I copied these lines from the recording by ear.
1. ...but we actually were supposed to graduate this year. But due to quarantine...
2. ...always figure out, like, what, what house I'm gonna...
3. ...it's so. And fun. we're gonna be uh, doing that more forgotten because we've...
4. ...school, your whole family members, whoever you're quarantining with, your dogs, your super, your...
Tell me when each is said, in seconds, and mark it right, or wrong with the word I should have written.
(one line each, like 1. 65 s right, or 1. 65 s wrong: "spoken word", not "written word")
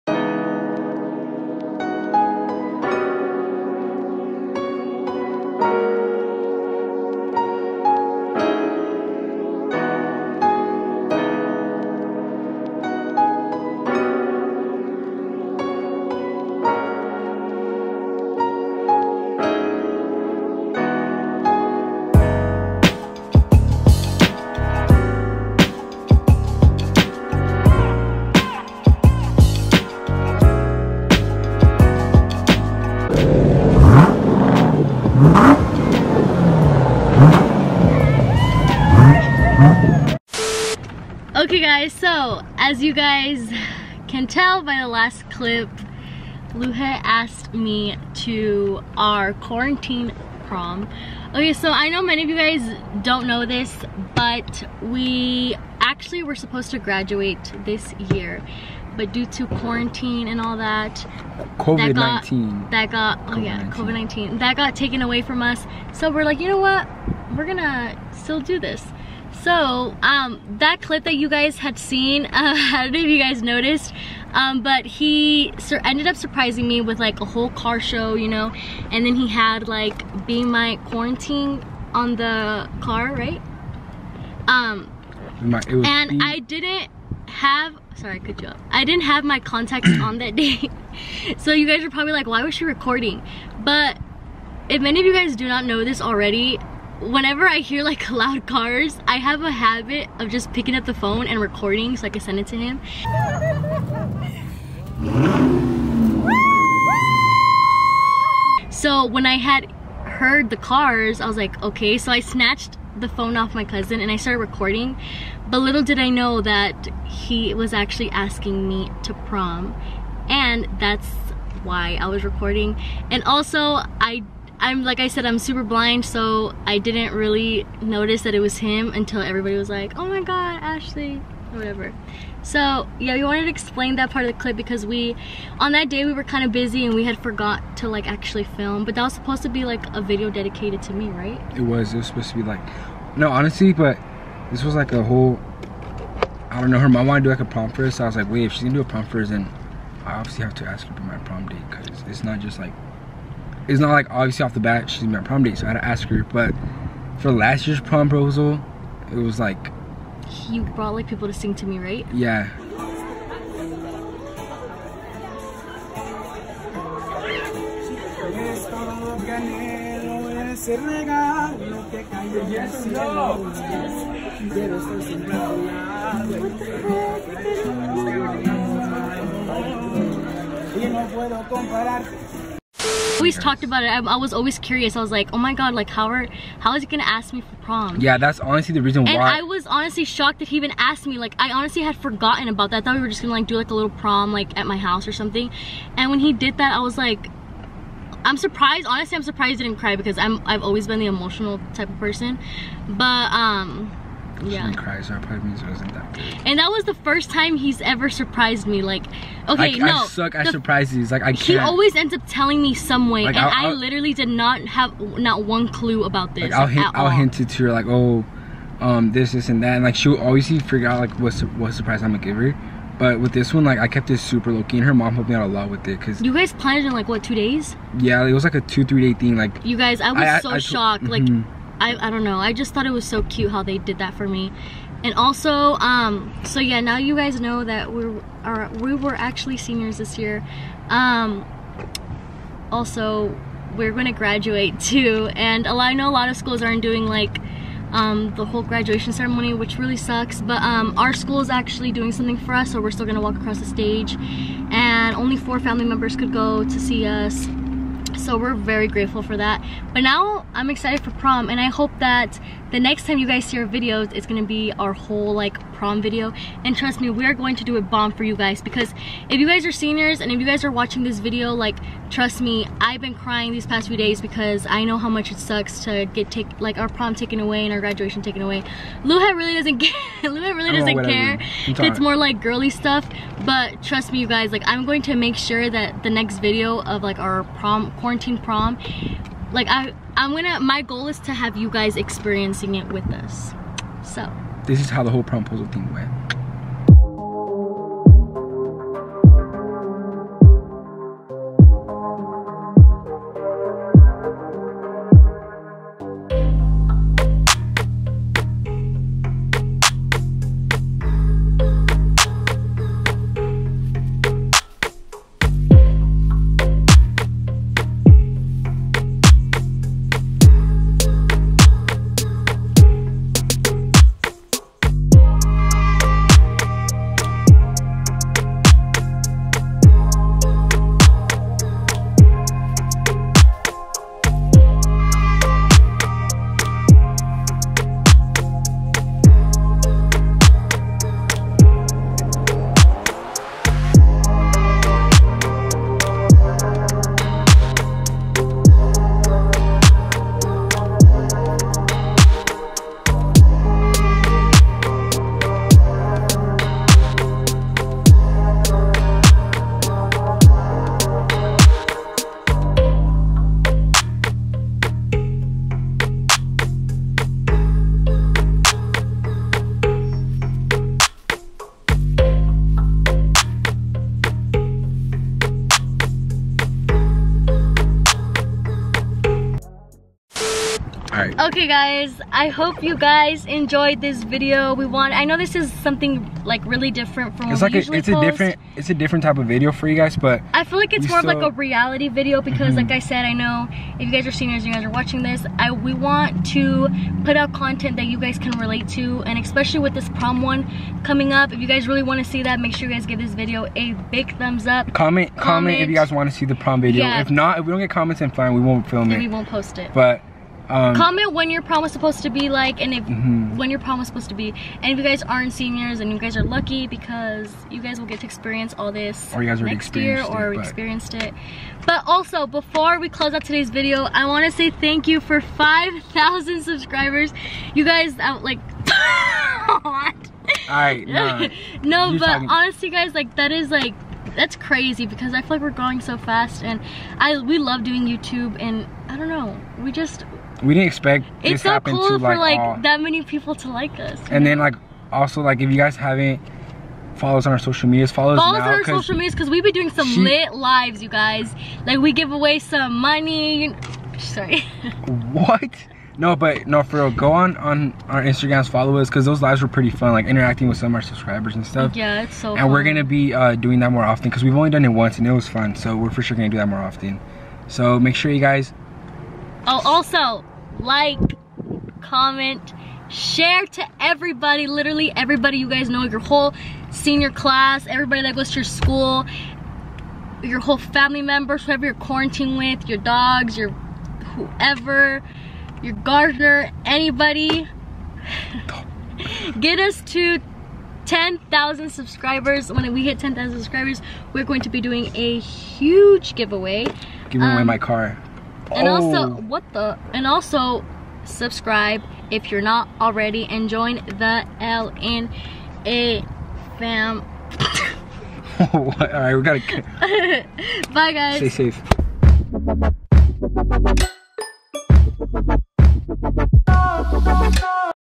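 1. 54 s right
2. 220 s wrong: "surprise", not "house"
3. 462 s wrong: "often", not "forgotten"
4. 478 s wrong: "whoever", not "super".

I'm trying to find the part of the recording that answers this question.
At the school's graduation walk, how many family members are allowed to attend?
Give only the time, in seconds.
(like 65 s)
255 s.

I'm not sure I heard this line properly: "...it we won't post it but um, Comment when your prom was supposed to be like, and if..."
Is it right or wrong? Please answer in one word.
right.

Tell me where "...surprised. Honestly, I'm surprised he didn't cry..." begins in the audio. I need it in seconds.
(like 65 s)
198 s.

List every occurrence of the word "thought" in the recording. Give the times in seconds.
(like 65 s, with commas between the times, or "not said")
192 s, 232 s.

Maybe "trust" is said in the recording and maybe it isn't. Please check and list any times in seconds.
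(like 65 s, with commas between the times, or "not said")
266 s, 272 s, 283 s.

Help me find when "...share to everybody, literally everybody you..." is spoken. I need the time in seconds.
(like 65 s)
473 s.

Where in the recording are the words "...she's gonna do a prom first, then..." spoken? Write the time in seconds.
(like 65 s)
148 s.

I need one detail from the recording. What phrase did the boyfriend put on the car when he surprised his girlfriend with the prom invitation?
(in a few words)
Be My Quarantine.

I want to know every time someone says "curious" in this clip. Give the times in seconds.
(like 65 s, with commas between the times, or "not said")
184 s.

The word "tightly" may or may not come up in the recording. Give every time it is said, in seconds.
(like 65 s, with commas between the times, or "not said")
not said.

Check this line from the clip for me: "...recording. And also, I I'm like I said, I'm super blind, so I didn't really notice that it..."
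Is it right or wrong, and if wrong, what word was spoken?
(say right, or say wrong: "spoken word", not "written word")
right.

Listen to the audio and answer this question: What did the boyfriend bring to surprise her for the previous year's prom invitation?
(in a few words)
People to sing.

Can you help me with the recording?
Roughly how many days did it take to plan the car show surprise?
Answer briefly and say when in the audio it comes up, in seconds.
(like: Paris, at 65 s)
2 to 3 days, at 228 s.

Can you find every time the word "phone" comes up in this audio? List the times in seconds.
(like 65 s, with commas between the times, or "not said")
100 s, 113 s.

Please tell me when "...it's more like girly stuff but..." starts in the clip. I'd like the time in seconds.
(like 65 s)
281 s.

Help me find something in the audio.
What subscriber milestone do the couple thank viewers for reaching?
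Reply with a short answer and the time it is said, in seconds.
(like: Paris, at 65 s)
5,000, at 425 s.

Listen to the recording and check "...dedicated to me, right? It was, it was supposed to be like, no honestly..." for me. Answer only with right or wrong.
right.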